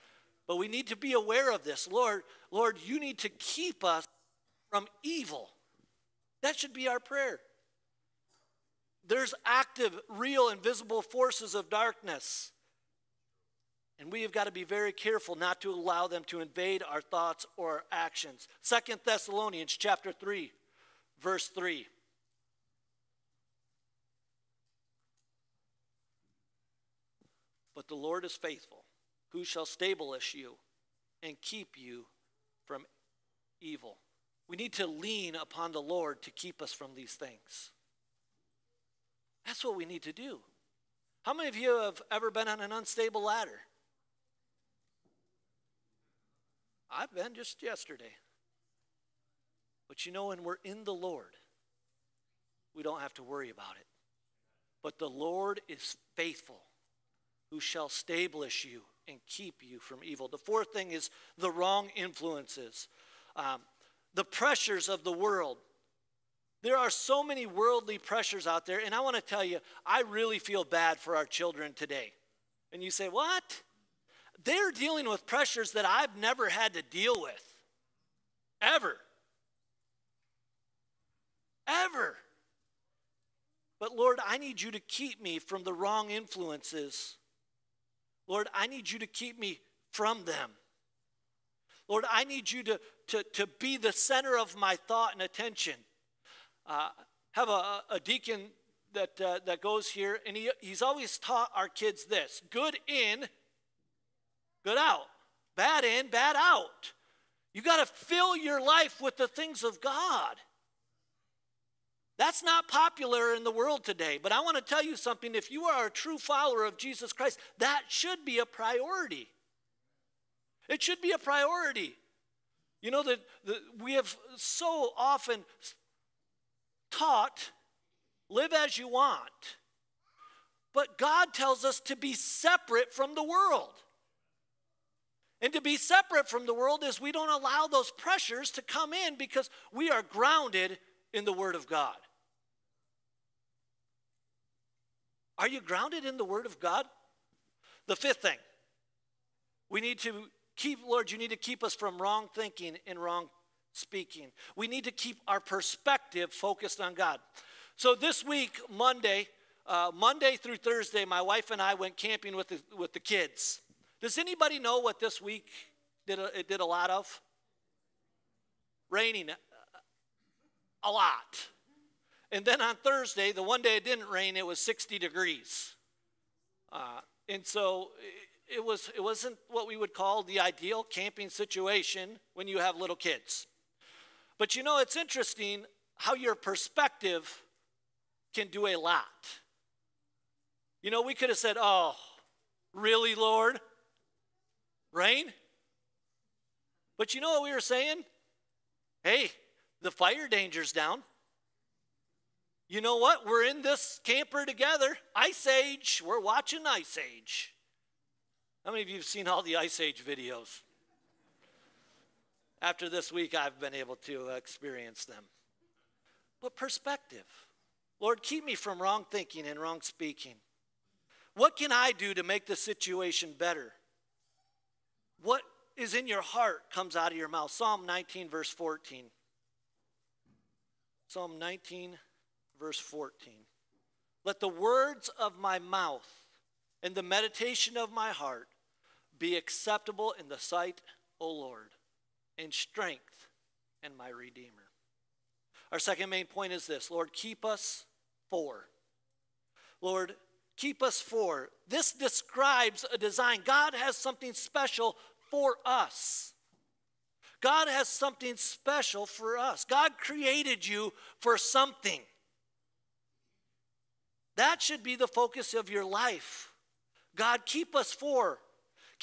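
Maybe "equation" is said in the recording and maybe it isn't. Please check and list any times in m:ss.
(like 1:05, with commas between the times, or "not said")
not said.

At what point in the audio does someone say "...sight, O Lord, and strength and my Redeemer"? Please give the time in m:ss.
4:00.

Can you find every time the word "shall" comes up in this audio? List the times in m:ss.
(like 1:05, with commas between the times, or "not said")
0:29, 0:57.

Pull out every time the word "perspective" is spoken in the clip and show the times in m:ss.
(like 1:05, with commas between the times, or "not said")
2:35, 3:06, 3:36.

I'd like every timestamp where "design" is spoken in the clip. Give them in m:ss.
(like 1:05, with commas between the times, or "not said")
4:12.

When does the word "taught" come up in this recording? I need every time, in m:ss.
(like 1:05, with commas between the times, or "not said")
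1:41, 2:06.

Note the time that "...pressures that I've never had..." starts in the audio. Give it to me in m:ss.
1:15.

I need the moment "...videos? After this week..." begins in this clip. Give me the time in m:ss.
3:30.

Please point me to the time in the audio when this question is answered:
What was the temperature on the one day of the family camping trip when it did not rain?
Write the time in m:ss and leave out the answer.
2:54.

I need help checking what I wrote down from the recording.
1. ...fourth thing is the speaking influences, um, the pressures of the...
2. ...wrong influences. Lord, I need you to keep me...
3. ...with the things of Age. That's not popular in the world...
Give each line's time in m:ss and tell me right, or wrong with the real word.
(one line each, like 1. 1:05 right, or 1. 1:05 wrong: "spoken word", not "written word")
1. 1:00 wrong: "wrong", not "speaking"
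2. 1:25 right
3. 1:49 wrong: "God", not "Age".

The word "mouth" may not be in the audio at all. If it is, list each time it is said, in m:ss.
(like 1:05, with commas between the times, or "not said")
3:47, 3:55.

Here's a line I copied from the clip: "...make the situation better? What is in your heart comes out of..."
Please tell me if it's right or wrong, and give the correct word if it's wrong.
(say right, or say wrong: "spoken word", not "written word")
right.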